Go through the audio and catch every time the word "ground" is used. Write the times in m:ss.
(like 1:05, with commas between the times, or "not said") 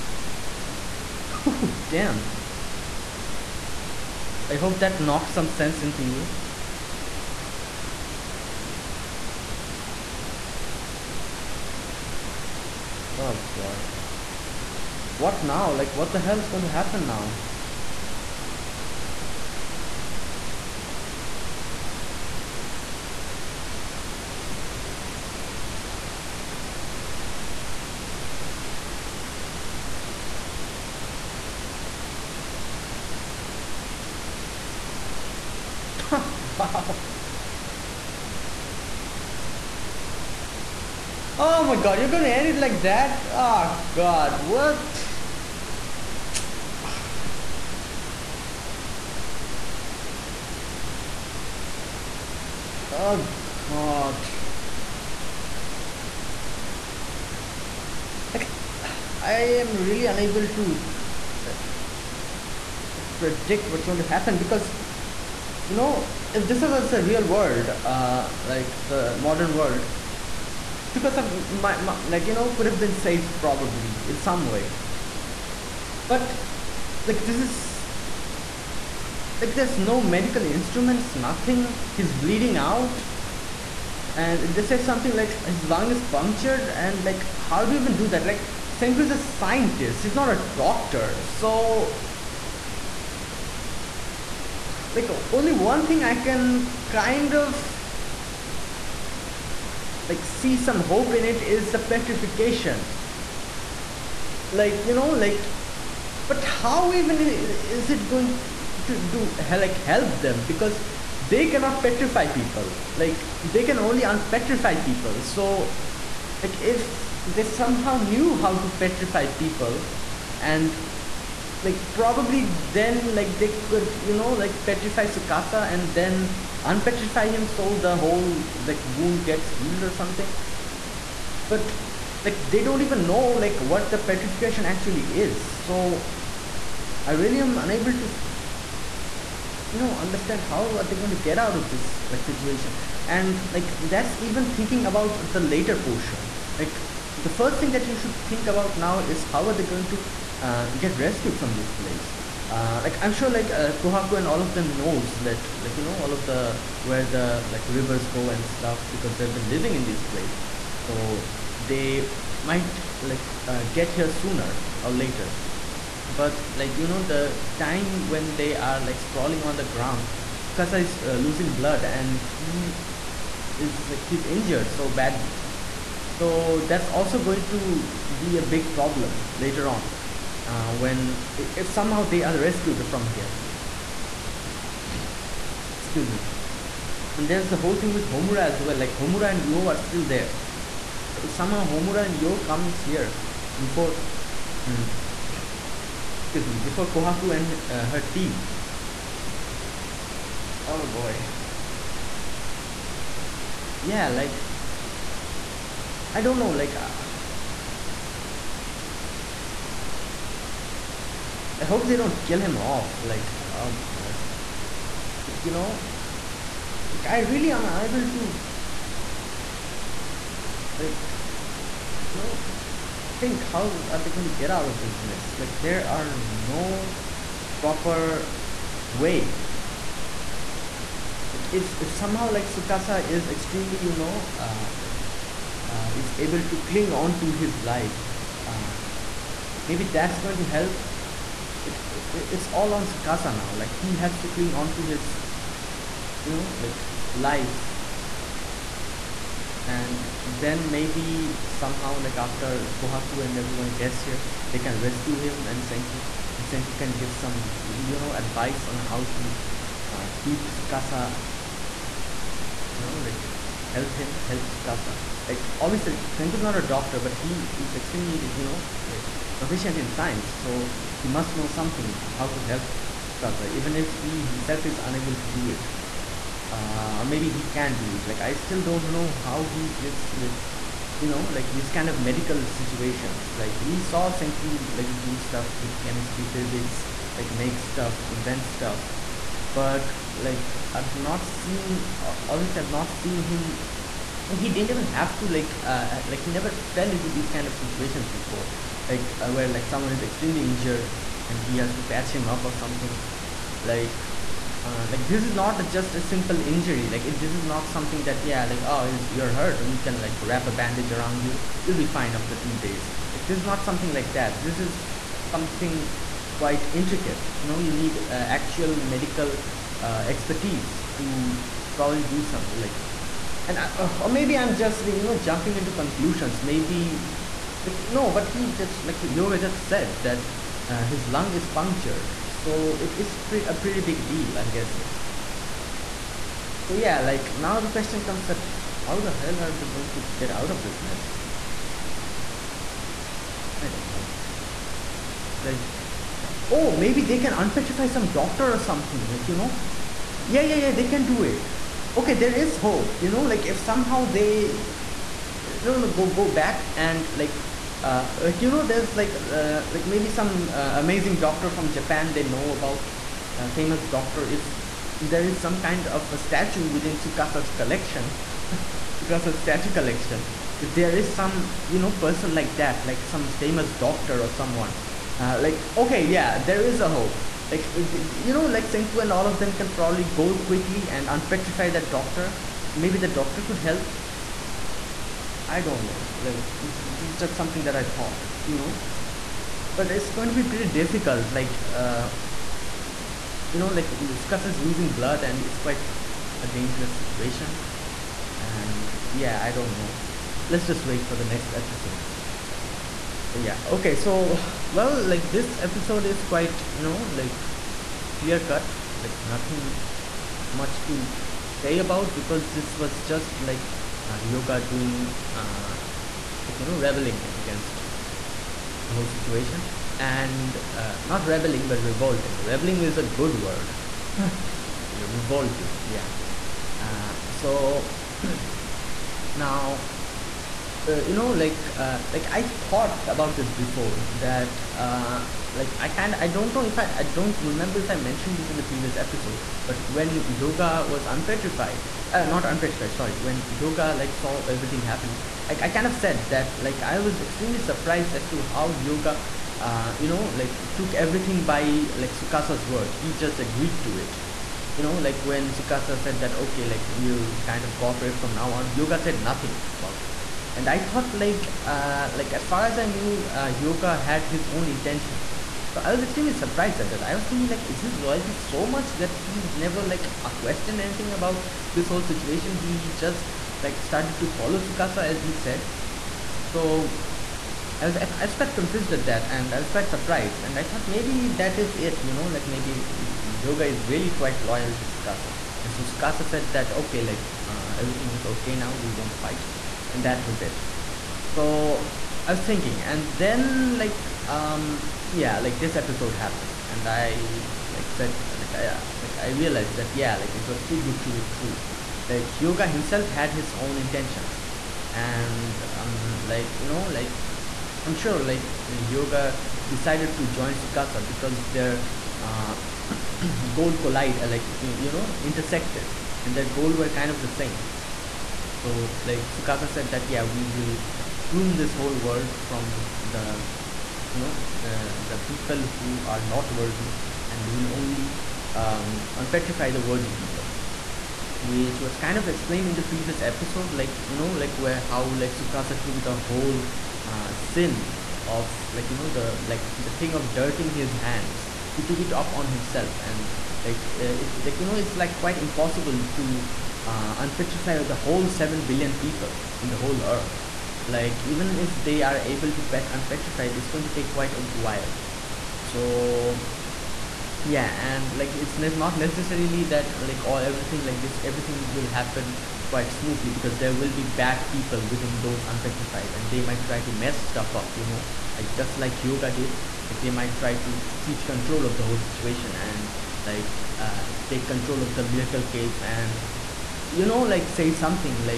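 2:49.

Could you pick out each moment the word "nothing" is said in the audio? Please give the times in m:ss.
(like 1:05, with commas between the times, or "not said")
1:21, 6:49, 7:39.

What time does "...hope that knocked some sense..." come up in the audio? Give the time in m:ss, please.
0:04.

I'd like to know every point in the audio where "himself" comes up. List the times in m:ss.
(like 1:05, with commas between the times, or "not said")
4:34, 8:22, 9:02.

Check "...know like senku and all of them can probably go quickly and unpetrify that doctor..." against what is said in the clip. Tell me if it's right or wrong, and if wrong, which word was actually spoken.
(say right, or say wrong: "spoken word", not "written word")
right.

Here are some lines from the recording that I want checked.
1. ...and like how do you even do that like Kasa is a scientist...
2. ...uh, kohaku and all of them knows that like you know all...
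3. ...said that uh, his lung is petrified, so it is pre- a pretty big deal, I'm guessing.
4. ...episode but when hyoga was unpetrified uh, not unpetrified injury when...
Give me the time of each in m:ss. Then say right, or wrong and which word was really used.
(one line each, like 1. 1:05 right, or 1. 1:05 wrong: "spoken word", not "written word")
1. 1:26 wrong: "Senku", not "Kasa"
2. 2:33 wrong: "kuhaku", not "kohaku"
3. 5:29 wrong: "punctured", not "petrified"
4. 7:18 wrong: "sorry", not "injury".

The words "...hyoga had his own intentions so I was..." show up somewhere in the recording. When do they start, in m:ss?
7:43.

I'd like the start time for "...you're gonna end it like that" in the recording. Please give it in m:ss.
0:41.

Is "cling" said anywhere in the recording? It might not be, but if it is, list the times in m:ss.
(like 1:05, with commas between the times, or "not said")
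3:56, 4:04.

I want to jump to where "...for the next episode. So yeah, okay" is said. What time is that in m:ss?
6:41.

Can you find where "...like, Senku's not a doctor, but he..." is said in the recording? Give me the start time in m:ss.
4:25.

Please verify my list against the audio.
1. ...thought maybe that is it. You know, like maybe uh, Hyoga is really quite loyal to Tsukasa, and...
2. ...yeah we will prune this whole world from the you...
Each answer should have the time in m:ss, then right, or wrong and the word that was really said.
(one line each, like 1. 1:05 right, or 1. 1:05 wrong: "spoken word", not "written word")
1. 8:00 right
2. 8:40 right.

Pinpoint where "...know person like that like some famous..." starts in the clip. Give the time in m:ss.
6:11.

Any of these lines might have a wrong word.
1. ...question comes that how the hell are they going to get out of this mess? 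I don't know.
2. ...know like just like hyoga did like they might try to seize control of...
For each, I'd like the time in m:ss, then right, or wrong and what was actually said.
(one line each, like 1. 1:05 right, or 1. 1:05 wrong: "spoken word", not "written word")
1. 5:37 right
2. 9:27 right.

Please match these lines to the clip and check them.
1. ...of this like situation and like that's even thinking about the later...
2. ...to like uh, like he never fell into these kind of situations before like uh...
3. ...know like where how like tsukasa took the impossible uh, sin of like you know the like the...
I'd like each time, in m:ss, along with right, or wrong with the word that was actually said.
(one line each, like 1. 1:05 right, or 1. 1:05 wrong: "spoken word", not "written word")
1. 2:21 right
2. 4:55 right
3. 8:54 wrong: "whole", not "impossible".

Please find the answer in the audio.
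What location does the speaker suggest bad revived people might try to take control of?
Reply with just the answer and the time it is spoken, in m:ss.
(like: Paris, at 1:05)
the miracle cave, at 9:35.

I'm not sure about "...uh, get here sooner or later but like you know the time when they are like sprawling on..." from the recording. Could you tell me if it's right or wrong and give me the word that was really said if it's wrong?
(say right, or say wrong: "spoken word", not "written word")
right.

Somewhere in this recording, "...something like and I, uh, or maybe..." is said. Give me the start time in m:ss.
5:22.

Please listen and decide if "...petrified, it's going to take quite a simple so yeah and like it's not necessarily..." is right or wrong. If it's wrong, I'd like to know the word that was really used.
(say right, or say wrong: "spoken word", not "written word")
wrong: "while", not "simple".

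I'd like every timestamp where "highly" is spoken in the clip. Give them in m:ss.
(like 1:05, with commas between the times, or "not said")
not said.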